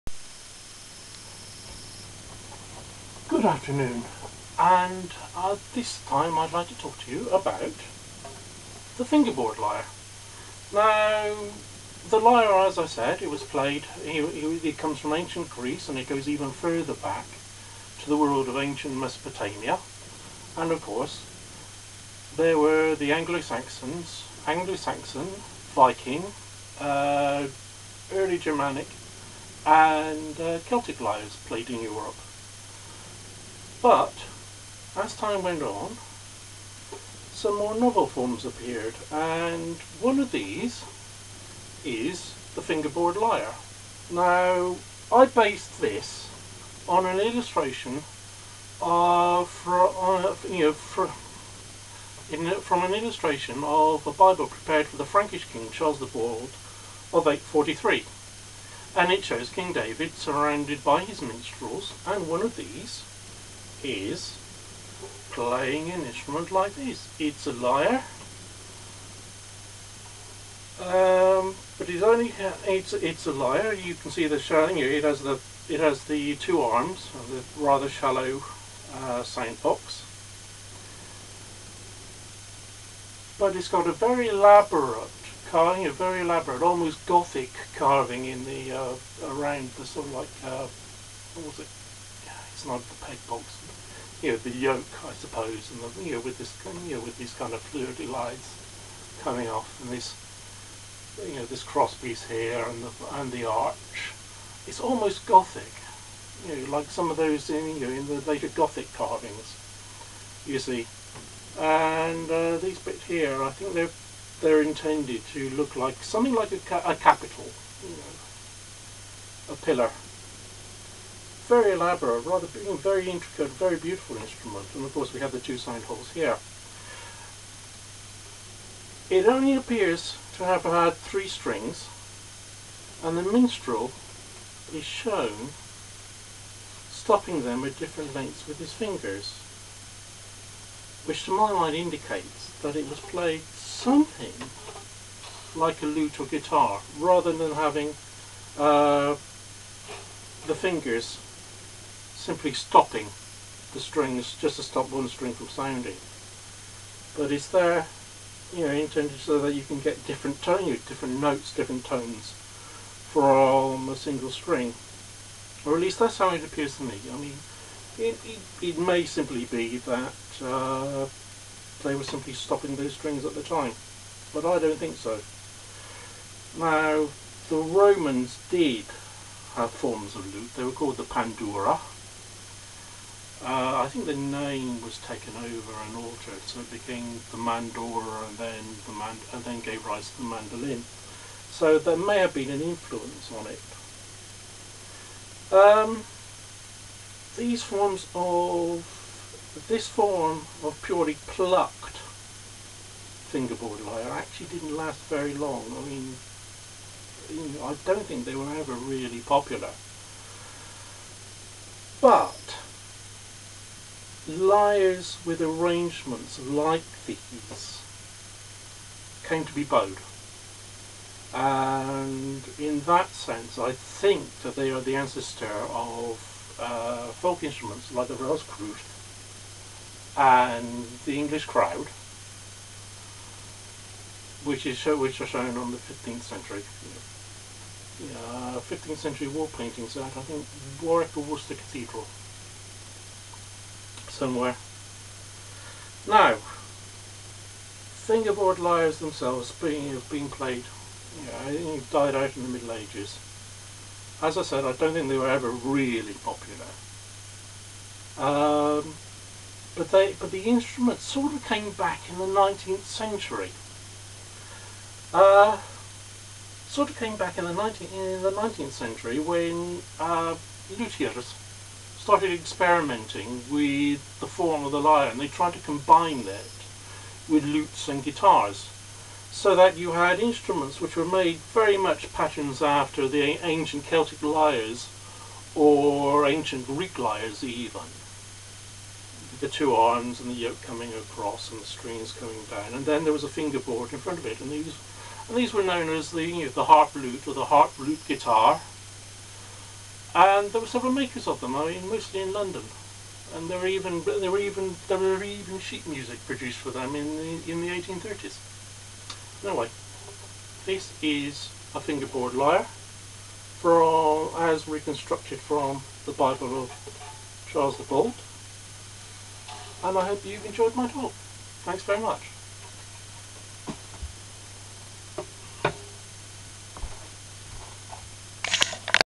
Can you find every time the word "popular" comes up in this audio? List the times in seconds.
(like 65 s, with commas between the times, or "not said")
209 s, 256 s.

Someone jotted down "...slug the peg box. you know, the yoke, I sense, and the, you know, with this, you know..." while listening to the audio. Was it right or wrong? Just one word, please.
wrong.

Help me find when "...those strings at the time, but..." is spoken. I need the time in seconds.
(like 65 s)
172 s.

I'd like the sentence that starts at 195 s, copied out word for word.
Um, these forms of this form of purely plucked fingerboard lyre actually didn't last very long.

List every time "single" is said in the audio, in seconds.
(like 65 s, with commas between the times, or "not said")
163 s.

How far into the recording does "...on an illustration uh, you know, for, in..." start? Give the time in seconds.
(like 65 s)
46 s.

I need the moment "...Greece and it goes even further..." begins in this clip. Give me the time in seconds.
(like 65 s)
15 s.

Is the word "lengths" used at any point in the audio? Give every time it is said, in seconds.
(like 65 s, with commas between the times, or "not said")
138 s.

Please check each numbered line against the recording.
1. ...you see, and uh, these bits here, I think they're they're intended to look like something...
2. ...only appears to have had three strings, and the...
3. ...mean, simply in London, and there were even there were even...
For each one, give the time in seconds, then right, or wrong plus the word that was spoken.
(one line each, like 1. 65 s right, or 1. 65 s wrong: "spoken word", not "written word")
1. 110 s right
2. 129 s right
3. 301 s wrong: "mostly", not "simply".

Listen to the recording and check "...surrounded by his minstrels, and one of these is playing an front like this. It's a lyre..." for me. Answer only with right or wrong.
wrong.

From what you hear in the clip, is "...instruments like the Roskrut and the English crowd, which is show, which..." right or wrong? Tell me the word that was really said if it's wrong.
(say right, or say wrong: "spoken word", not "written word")
right.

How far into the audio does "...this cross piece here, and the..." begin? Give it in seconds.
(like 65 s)
101 s.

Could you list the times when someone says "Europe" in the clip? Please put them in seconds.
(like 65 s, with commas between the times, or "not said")
31 s.